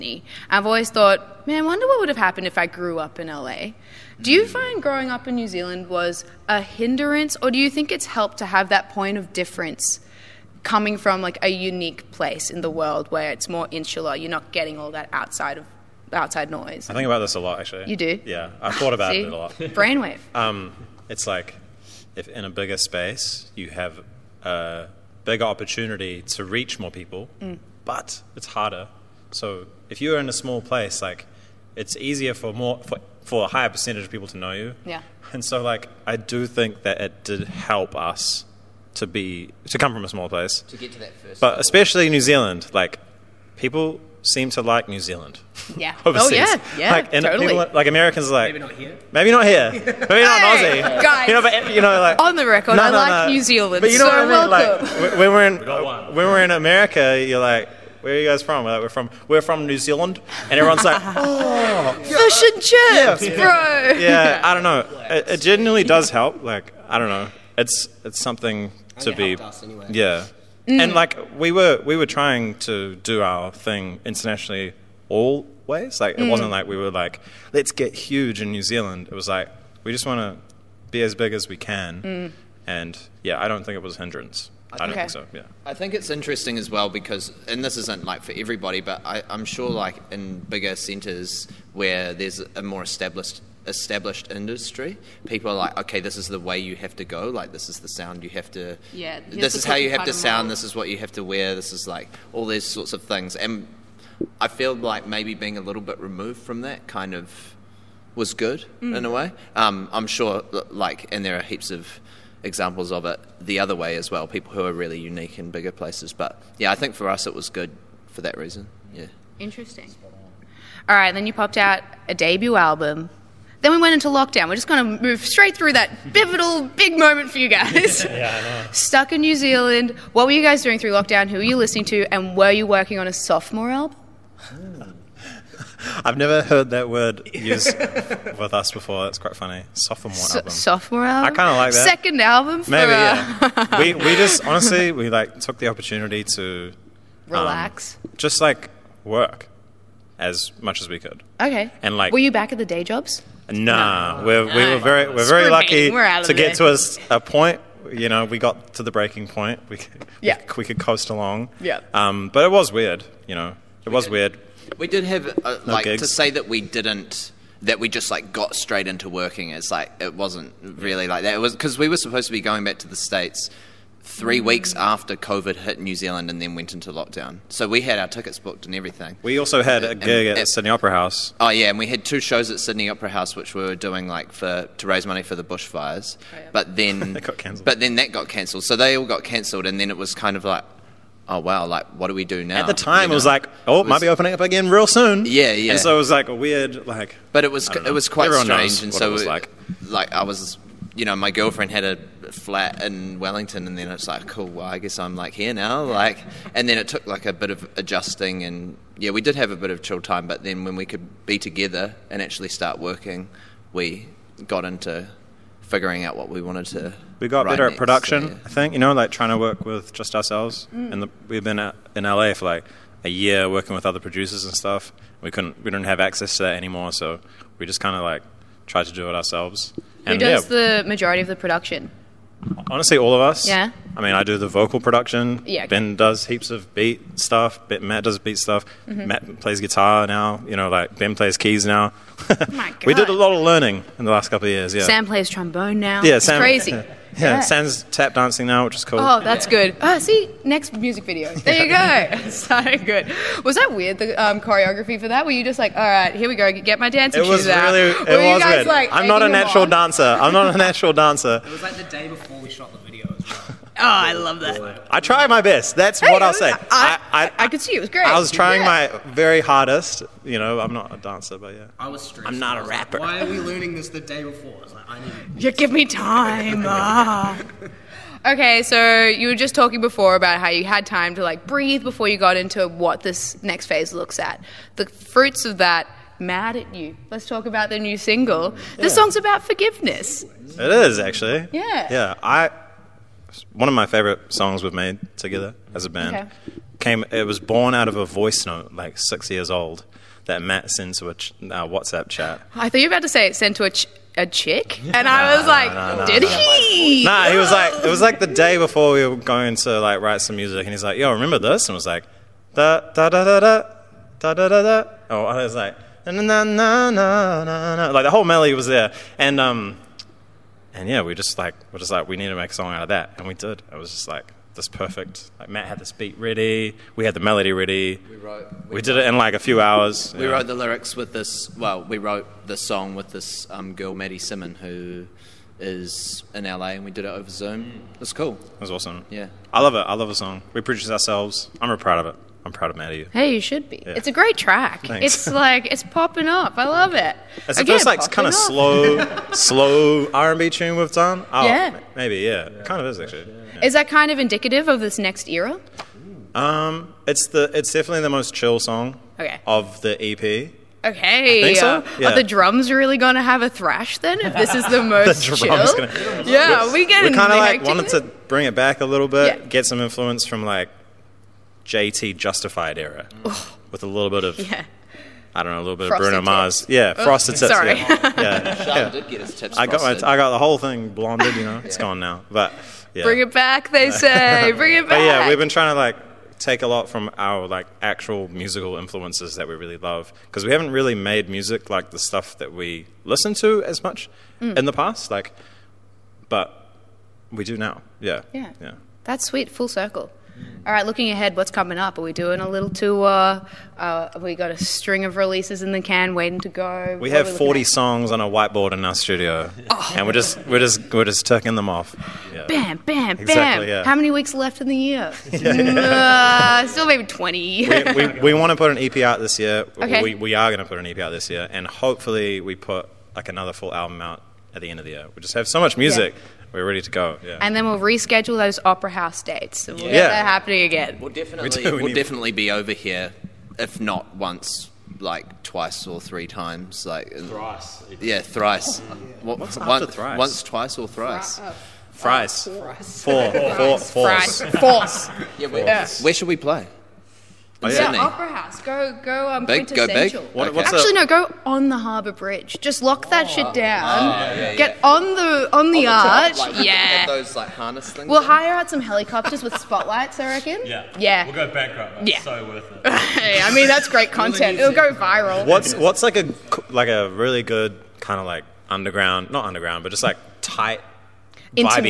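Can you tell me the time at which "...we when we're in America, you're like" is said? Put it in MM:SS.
00:55.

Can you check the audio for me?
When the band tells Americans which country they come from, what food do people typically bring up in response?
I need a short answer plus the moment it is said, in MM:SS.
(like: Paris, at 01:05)
Fish and chips, at 01:02.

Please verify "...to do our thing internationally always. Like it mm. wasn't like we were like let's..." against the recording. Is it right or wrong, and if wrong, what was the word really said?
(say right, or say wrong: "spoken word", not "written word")
right.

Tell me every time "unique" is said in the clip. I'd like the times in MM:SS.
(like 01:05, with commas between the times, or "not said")
00:11, 01:54.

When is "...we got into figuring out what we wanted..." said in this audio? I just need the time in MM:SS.
03:33.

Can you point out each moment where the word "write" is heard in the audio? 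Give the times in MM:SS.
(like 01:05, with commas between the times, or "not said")
05:09.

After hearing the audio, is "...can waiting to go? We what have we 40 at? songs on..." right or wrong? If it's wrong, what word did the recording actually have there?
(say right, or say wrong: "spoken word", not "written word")
right.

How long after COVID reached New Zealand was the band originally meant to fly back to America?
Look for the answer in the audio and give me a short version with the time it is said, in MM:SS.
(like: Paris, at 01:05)
Three weeks, at 02:54.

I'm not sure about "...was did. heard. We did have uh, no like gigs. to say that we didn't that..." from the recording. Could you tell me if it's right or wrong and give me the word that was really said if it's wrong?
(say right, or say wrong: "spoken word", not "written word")
wrong: "weird", not "heard".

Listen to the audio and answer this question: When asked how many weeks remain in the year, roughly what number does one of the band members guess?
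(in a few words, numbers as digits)
20.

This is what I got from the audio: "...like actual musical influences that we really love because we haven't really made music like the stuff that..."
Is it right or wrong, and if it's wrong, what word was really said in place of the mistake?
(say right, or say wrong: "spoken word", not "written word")
right.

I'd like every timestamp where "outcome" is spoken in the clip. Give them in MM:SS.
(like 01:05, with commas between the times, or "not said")
not said.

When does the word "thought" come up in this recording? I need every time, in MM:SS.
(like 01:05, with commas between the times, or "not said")
00:00, 00:18, 05:02.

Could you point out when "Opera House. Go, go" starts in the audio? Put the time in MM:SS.
07:28.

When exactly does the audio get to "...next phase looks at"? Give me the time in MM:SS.
04:43.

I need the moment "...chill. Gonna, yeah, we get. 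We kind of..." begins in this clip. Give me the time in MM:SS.
06:05.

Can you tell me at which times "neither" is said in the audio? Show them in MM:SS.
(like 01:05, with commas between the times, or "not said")
not said.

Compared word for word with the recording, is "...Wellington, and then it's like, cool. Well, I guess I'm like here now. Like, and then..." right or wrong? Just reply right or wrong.
right.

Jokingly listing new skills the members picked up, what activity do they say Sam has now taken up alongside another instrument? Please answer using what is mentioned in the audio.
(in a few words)
Tap dancing.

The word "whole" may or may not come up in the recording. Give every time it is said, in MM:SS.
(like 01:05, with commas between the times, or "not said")
05:18, 06:20.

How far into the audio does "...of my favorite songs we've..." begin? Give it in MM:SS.
04:53.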